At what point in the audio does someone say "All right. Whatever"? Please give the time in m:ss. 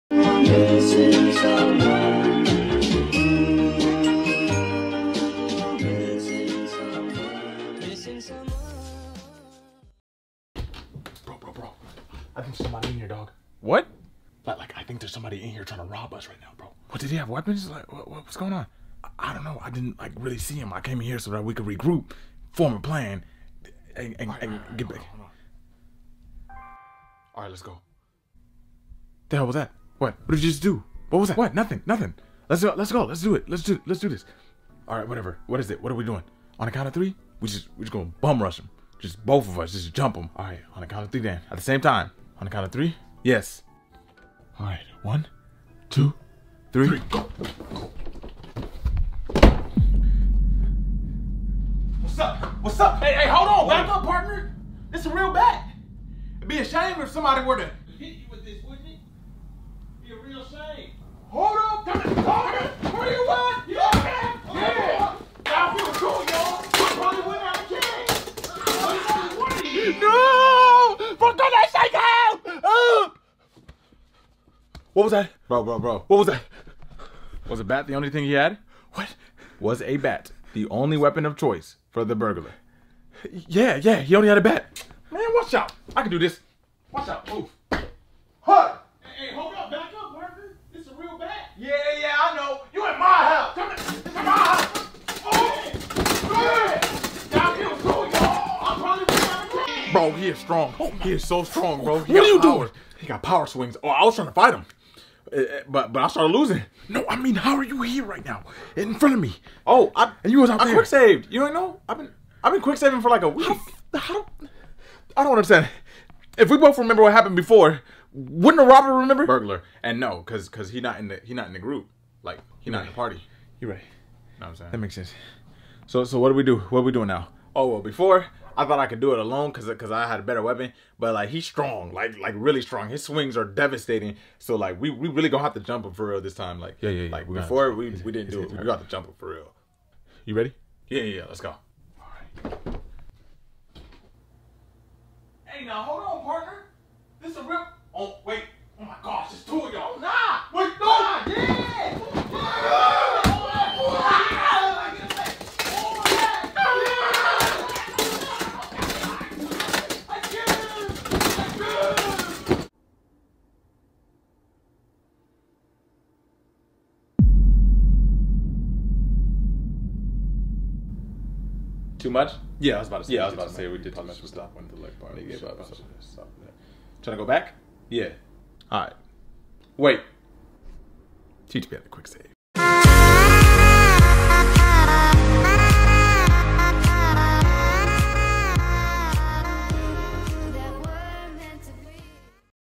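0:34.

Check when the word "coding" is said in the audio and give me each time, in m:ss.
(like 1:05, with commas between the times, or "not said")
not said.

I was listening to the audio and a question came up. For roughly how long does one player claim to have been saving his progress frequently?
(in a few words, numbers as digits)
A week.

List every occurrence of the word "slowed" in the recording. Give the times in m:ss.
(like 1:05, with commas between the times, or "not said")
not said.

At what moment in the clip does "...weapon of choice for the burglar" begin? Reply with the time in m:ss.
1:20.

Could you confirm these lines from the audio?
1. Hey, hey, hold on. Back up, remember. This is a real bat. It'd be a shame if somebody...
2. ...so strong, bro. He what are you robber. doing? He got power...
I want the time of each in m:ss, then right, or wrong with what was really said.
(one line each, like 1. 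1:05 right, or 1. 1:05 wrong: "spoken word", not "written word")
1. 0:53 wrong: "partner", not "remember"
2. 1:41 wrong: "power", not "robber".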